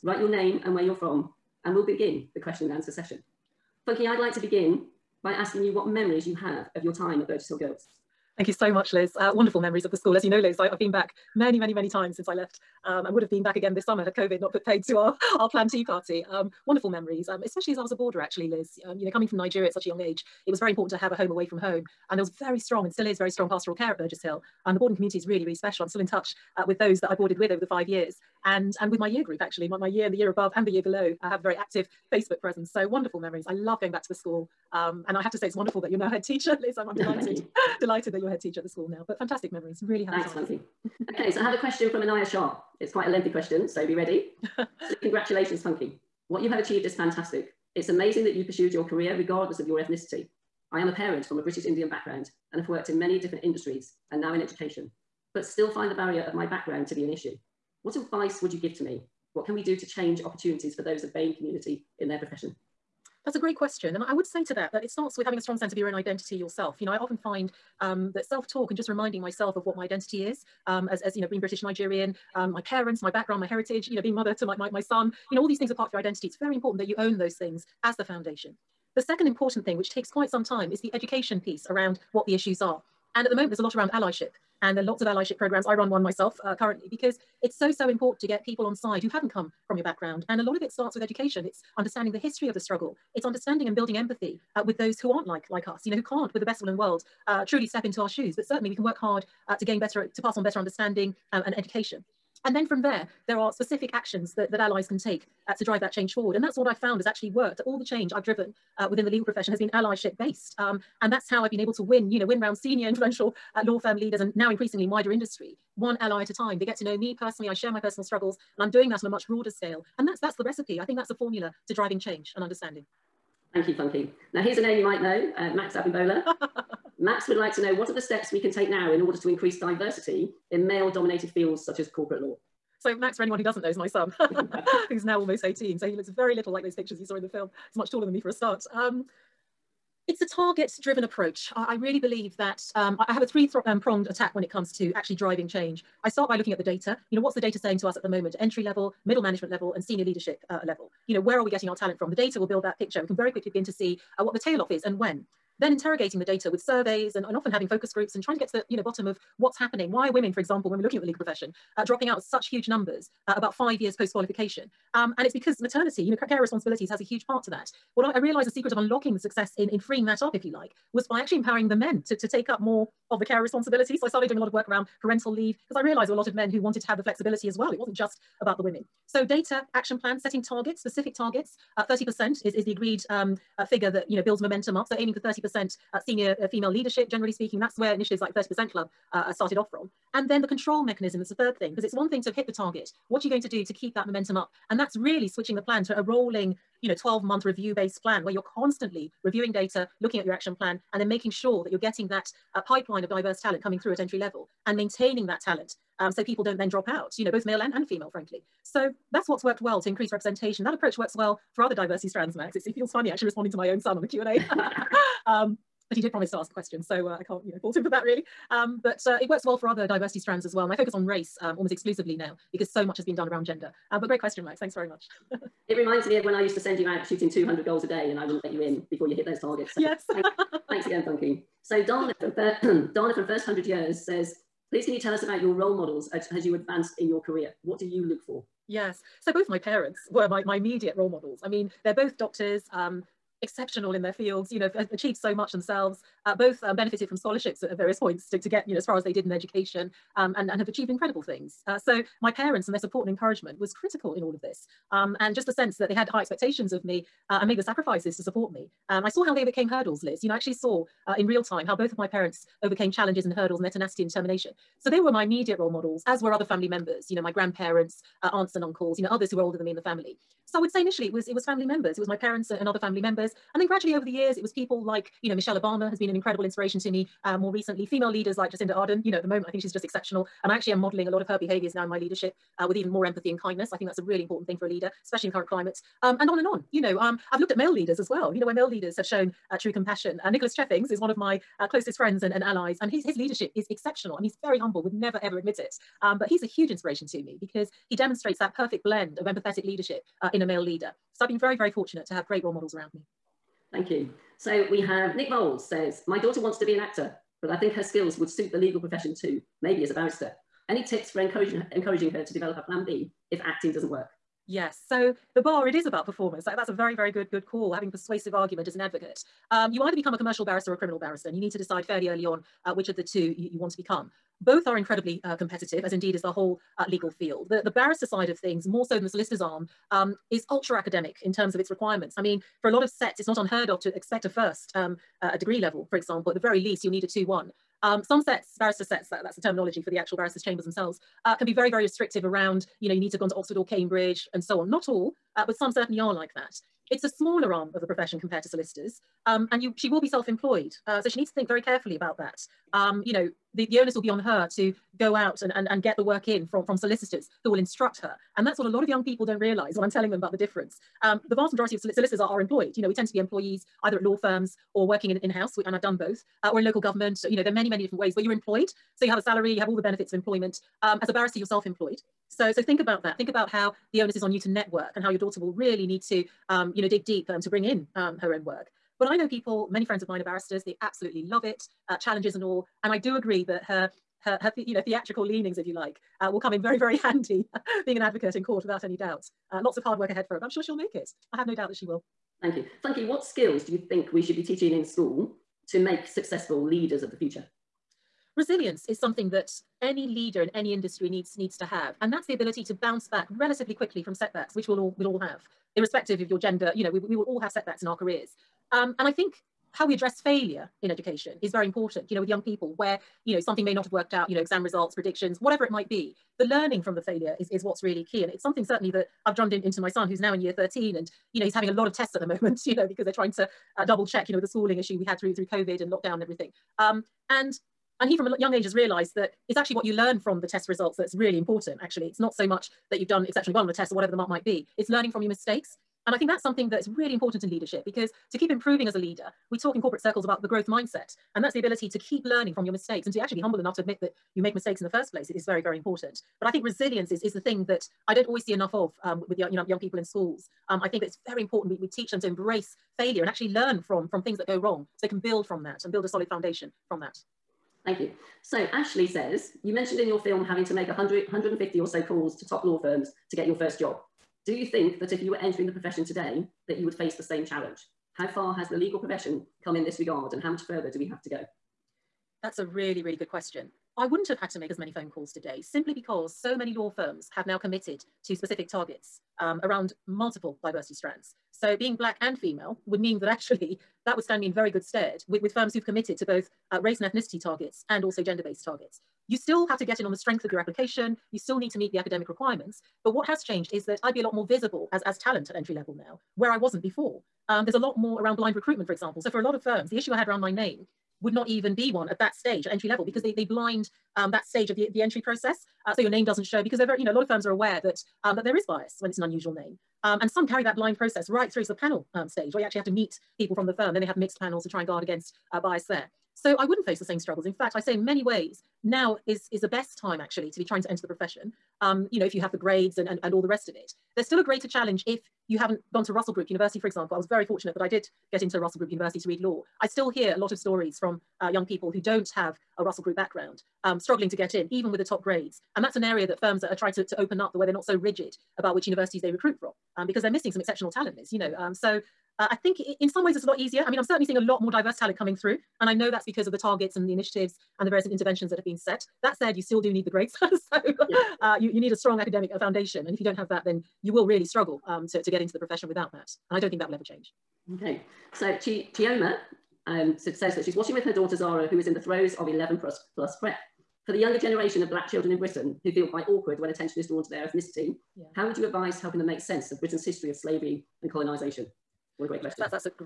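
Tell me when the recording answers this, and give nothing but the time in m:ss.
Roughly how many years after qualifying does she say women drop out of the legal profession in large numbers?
2:43.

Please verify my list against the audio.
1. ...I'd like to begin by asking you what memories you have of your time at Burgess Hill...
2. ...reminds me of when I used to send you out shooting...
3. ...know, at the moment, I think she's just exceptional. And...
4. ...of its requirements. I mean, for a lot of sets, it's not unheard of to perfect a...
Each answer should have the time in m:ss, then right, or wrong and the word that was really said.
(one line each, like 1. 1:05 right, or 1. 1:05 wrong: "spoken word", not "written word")
1. 0:04 right
2. 3:45 right
3. 4:39 right
4. 5:31 wrong: "expect", not "perfect".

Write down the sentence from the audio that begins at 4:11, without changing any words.
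Uh, so my parents and their support and encouragement was critical in all of this.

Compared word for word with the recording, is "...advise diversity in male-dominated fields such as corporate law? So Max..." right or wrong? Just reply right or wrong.
wrong.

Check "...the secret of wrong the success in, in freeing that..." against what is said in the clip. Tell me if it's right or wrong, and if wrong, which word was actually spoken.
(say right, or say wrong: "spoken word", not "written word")
wrong: "unlocking", not "wrong".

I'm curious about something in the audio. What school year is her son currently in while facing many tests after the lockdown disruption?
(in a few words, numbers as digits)
Year 13.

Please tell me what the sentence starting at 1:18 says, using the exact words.
The second important thing, which takes quite some time, is the education piece around what the issues are.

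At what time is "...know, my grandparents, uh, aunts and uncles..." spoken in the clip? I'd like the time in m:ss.
4:27.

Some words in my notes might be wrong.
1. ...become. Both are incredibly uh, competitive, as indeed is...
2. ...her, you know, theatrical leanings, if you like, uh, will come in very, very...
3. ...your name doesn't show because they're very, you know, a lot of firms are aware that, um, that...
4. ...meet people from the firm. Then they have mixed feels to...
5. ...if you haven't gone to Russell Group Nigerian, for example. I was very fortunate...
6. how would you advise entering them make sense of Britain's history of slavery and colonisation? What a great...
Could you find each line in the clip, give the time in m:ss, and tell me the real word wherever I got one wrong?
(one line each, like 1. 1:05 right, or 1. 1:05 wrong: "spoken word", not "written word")
1. 5:23 right
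2. 6:24 right
3. 8:26 right
4. 8:32 wrong: "panels", not "feels"
5. 8:45 wrong: "University", not "Nigerian"
6. 9:28 wrong: "helping", not "entering".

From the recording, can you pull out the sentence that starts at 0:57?
What advice would you give to me?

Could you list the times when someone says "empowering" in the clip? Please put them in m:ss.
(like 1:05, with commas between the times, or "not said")
2:51.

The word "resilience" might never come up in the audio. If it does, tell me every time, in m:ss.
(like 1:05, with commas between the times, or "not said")
6:38, 7:26.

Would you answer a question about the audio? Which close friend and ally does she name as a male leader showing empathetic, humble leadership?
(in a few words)
Nicholas Cheffings.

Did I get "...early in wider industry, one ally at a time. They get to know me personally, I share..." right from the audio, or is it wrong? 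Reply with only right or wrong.
wrong.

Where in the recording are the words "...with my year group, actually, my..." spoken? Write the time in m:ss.
0:28.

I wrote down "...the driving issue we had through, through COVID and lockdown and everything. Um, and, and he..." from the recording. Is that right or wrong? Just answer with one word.
wrong.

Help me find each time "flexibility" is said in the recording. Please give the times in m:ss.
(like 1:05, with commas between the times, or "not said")
2:57.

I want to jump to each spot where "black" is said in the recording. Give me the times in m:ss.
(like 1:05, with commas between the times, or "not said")
8:01, 9:24.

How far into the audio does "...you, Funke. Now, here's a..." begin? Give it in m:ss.
2:03.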